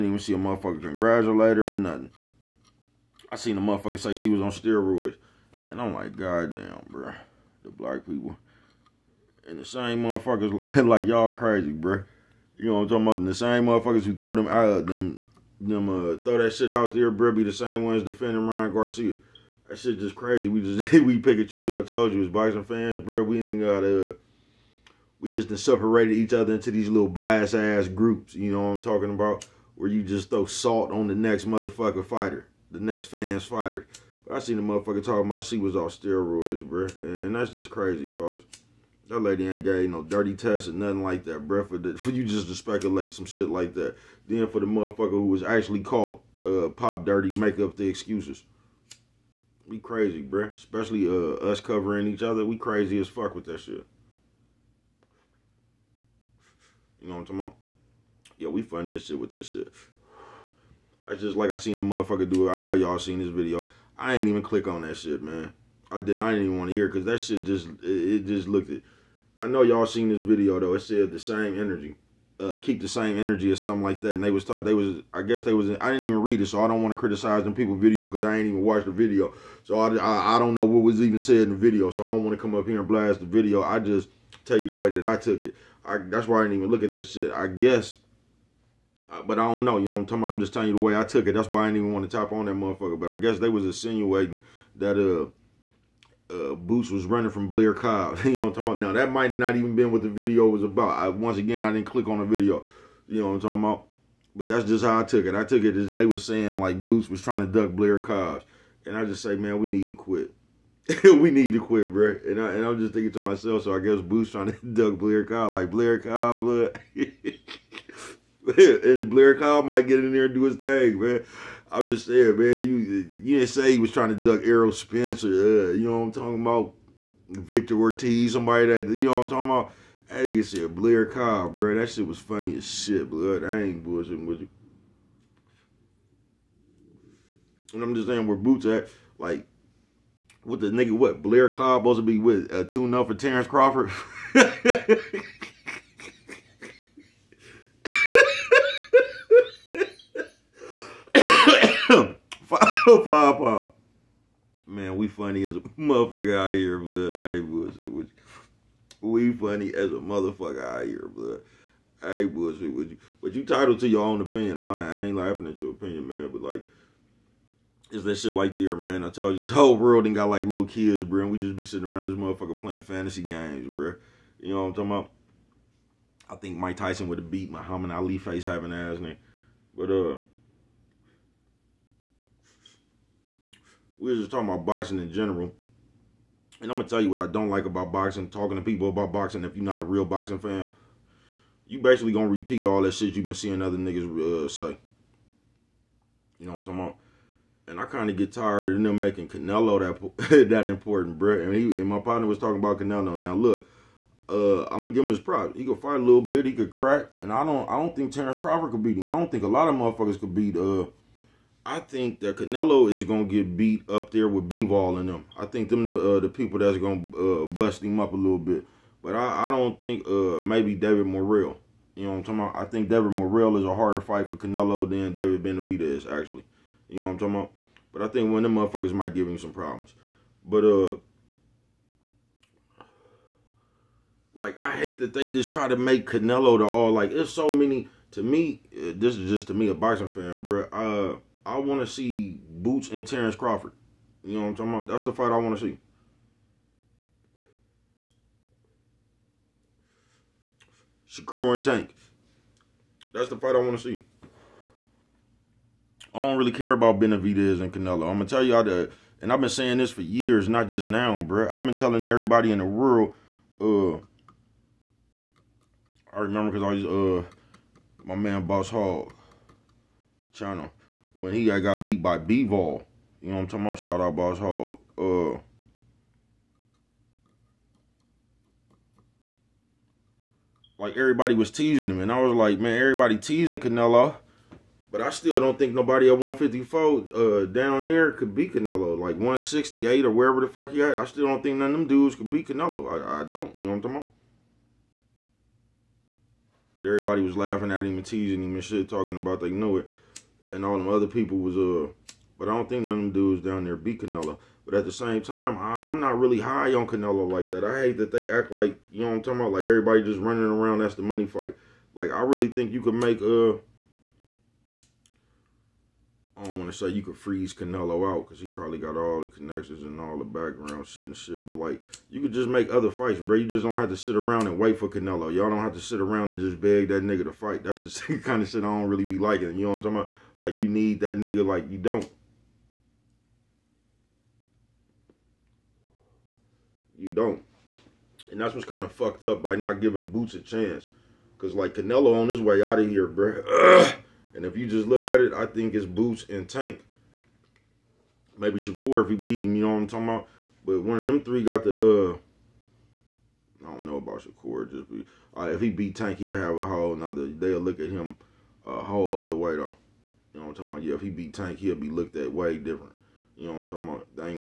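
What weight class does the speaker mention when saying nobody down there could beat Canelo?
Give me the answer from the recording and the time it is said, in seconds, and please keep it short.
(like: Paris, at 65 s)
154, at 286 s.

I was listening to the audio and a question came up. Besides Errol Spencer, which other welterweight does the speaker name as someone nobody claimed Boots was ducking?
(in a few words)
Victor Ortiz.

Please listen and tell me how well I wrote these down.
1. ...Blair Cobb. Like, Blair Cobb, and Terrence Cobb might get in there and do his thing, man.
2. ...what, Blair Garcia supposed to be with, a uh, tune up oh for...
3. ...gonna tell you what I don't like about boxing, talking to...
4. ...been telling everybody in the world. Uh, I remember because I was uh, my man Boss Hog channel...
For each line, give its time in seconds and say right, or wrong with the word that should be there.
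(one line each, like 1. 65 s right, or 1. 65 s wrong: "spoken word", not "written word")
1. 114 s wrong: "Blair", not "Terrence"
2. 140 s wrong: "Cobb", not "Garcia"
3. 186 s right
4. 261 s right.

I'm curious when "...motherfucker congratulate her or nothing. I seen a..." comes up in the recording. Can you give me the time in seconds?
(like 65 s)
0 s.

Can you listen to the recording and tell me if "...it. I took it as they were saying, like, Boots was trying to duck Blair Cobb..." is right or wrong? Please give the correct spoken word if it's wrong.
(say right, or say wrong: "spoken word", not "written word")
right.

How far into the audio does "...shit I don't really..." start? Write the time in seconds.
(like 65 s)
328 s.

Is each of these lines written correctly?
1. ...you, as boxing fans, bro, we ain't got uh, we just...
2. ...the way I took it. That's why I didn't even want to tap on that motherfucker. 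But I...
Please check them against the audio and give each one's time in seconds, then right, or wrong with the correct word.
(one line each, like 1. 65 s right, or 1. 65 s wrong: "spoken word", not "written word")
1. 22 s right
2. 90 s right.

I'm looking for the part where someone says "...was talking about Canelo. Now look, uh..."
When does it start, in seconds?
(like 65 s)
202 s.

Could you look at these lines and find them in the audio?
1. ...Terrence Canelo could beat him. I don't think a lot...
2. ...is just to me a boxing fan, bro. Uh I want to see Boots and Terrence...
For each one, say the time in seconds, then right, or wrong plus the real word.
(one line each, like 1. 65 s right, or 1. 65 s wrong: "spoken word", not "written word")
1. 208 s wrong: "Crawford", not "Canelo"
2. 239 s right.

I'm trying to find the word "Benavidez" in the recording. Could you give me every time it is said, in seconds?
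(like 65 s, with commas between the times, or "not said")
225 s, 256 s.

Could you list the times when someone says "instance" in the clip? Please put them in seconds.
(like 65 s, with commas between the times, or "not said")
not said.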